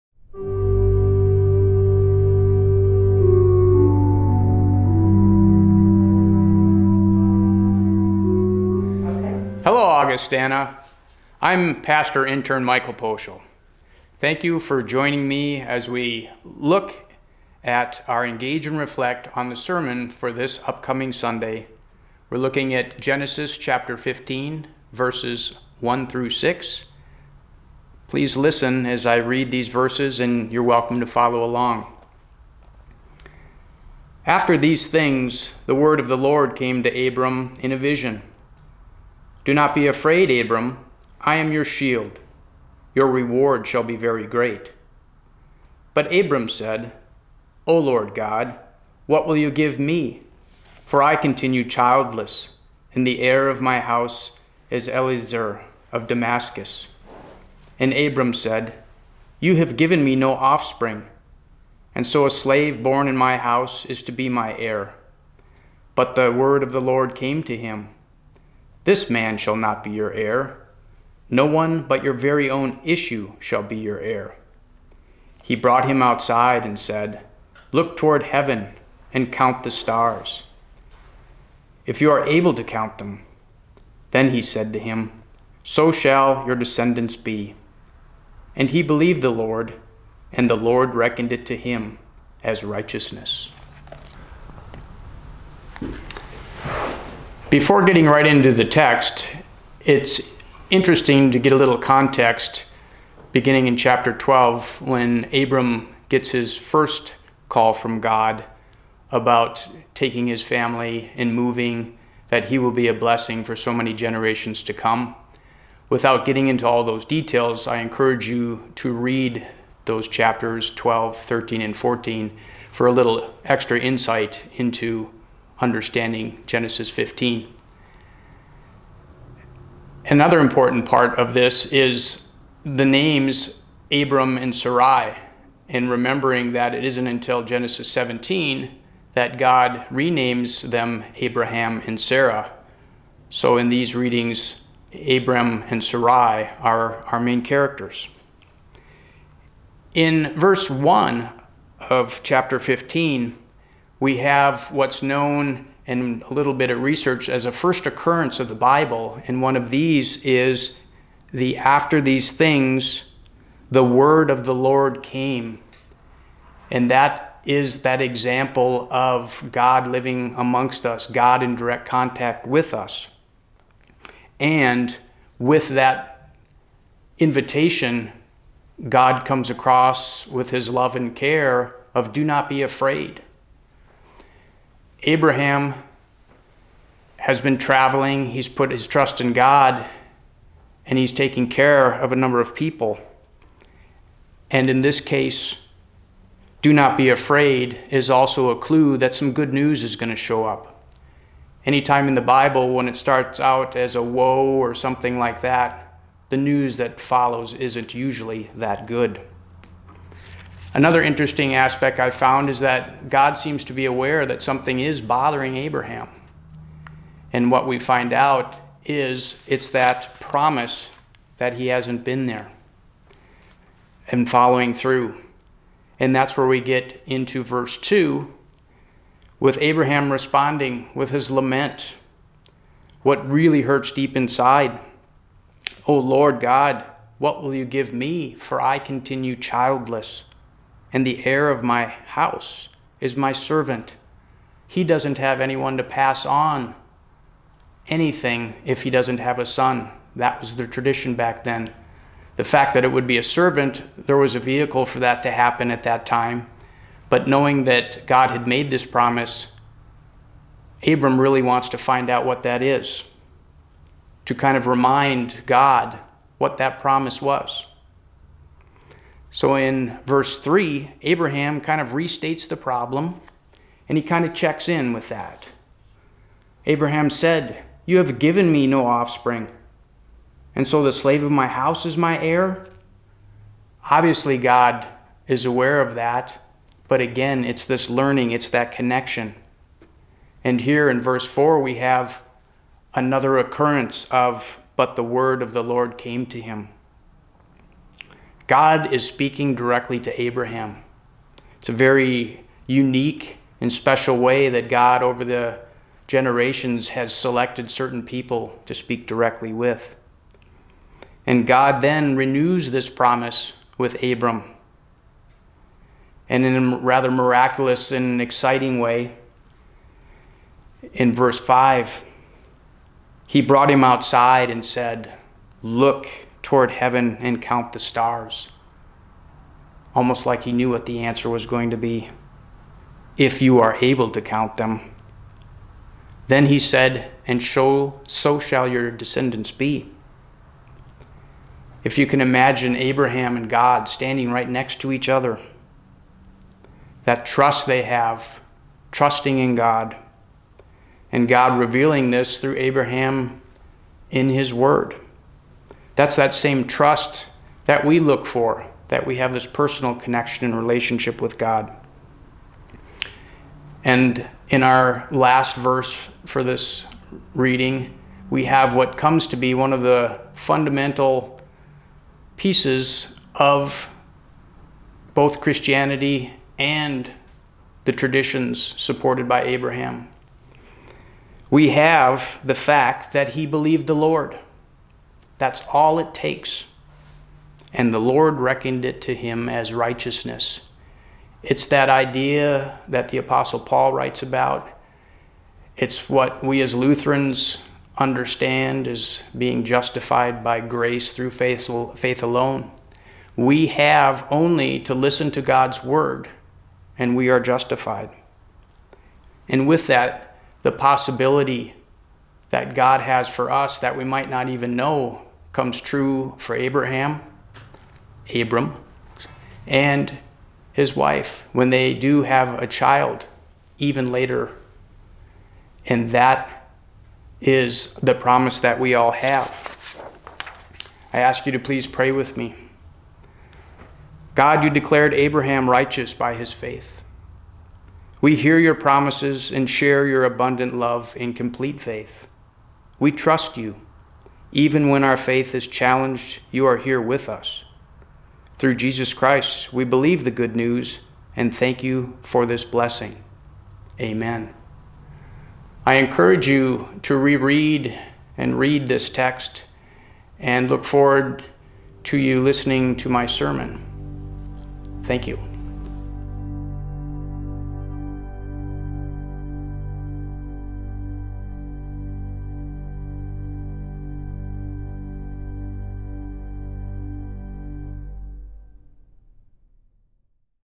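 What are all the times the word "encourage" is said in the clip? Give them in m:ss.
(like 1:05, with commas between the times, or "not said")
1:57, 7:35.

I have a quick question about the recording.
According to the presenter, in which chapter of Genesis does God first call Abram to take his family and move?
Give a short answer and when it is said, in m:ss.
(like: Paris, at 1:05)
Chapter 12, at 1:43.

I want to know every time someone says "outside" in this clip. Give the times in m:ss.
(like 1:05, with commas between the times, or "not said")
1:16, 5:23.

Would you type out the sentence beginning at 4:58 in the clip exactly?
God is speaking directly to Abraham.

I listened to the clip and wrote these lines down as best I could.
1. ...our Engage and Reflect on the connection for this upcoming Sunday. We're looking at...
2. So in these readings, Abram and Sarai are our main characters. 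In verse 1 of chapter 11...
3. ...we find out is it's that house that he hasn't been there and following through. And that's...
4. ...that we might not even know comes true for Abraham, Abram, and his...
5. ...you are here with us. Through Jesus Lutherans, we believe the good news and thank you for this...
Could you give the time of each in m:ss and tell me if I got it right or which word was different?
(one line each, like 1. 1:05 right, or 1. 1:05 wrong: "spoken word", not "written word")
1. 0:18 wrong: "sermon", not "connection"
2. 2:23 wrong: "15", not "11"
3. 3:37 wrong: "promise", not "house"
4. 6:53 right
5. 7:26 wrong: "Christ", not "Lutherans".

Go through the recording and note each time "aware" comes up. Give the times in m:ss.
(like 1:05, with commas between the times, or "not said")
3:33, 4:45.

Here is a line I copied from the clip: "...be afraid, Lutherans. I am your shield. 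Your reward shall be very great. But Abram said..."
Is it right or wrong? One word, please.
wrong.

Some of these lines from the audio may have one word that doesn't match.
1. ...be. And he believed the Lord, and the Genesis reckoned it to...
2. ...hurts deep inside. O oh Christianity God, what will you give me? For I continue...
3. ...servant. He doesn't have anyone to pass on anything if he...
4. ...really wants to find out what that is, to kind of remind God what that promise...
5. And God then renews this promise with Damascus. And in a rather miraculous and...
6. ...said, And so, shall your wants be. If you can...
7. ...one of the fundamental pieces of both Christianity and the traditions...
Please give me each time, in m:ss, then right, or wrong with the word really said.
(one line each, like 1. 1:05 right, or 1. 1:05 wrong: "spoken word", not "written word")
1. 1:27 wrong: "Lord", not "Genesis"
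2. 3:53 wrong: "Lord", not "Christianity"
3. 4:03 right
4. 4:21 right
5. 5:11 wrong: "Abram", not "Damascus"
6. 5:36 wrong: "descendants", not "wants"
7. 6:09 right.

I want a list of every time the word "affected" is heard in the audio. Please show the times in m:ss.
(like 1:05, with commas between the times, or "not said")
not said.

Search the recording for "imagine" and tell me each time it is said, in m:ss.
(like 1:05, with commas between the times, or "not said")
5:42.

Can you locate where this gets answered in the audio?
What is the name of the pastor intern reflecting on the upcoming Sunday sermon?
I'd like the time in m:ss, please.
0:12.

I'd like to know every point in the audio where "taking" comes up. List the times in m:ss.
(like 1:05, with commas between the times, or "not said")
1:49, 3:11.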